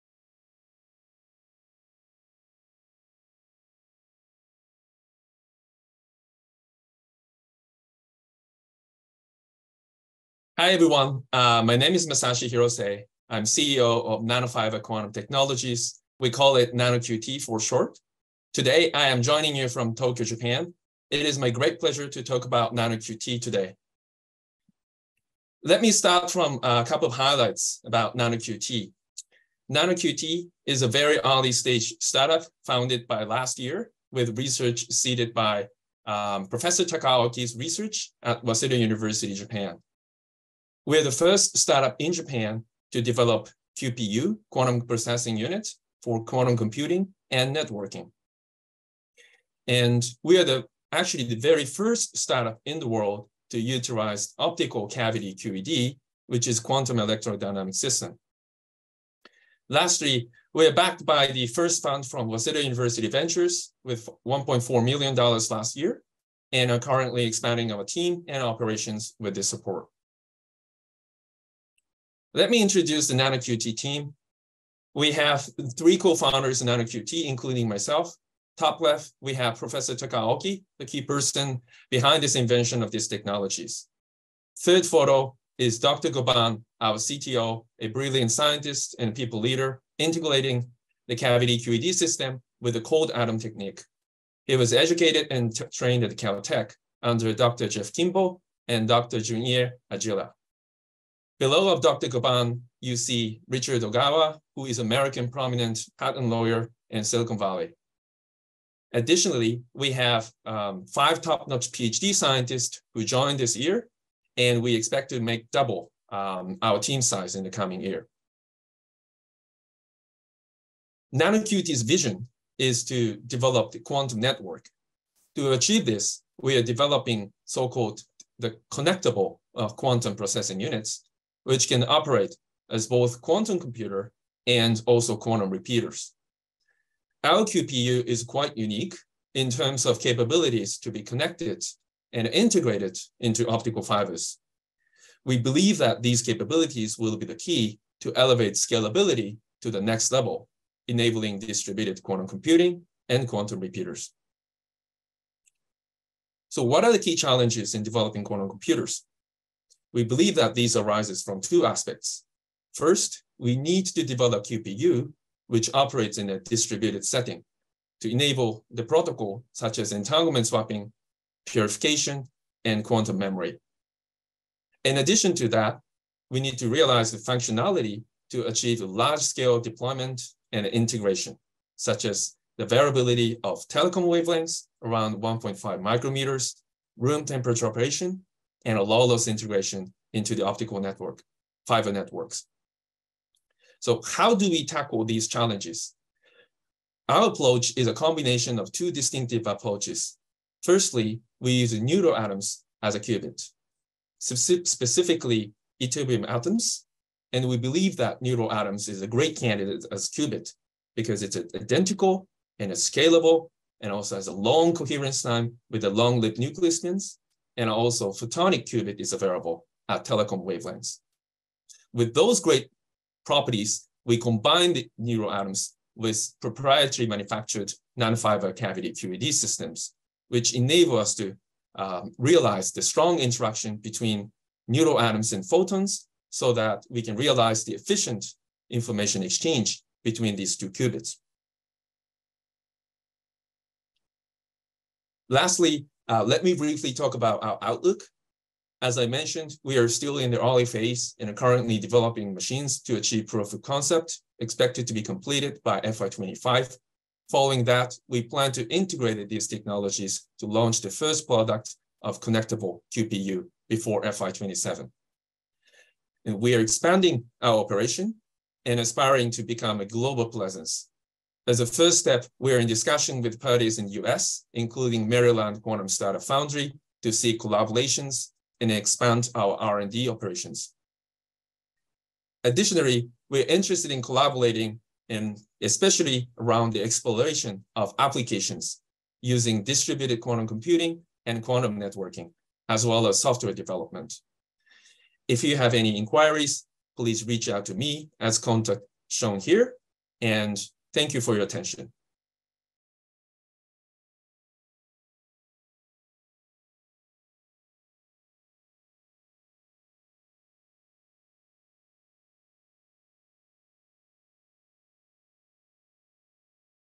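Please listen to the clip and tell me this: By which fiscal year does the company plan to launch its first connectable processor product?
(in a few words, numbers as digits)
FY27.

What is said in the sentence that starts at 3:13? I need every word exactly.
So how do we tackle these challenges?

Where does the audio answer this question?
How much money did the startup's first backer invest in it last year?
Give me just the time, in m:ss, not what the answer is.
1:04.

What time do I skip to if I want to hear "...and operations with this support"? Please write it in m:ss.
1:08.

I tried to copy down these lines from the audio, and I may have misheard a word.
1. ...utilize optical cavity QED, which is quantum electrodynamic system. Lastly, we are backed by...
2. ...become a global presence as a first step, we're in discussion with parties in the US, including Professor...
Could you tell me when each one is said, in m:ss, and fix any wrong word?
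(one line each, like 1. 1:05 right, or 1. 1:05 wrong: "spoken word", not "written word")
1. 0:53 right
2. 4:29 wrong: "Maryland", not "Professor".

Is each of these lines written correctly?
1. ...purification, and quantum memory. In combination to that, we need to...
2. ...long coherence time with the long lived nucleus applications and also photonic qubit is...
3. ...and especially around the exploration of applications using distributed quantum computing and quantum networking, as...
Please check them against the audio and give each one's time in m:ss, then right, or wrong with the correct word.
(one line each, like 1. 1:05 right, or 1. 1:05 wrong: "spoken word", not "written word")
1. 2:51 wrong: "addition", not "combination"
2. 3:34 wrong: "spins", not "applications"
3. 4:45 right.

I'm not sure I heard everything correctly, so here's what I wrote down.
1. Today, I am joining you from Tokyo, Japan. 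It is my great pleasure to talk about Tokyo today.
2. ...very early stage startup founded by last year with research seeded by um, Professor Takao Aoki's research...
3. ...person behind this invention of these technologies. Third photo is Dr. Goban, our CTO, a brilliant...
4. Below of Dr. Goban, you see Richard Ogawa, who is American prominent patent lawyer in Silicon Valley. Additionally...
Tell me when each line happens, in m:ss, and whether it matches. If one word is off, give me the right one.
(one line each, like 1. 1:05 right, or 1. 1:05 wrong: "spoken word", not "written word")
1. 0:18 wrong: "NanoQT", not "Tokyo"
2. 0:30 right
3. 1:21 right
4. 1:41 right.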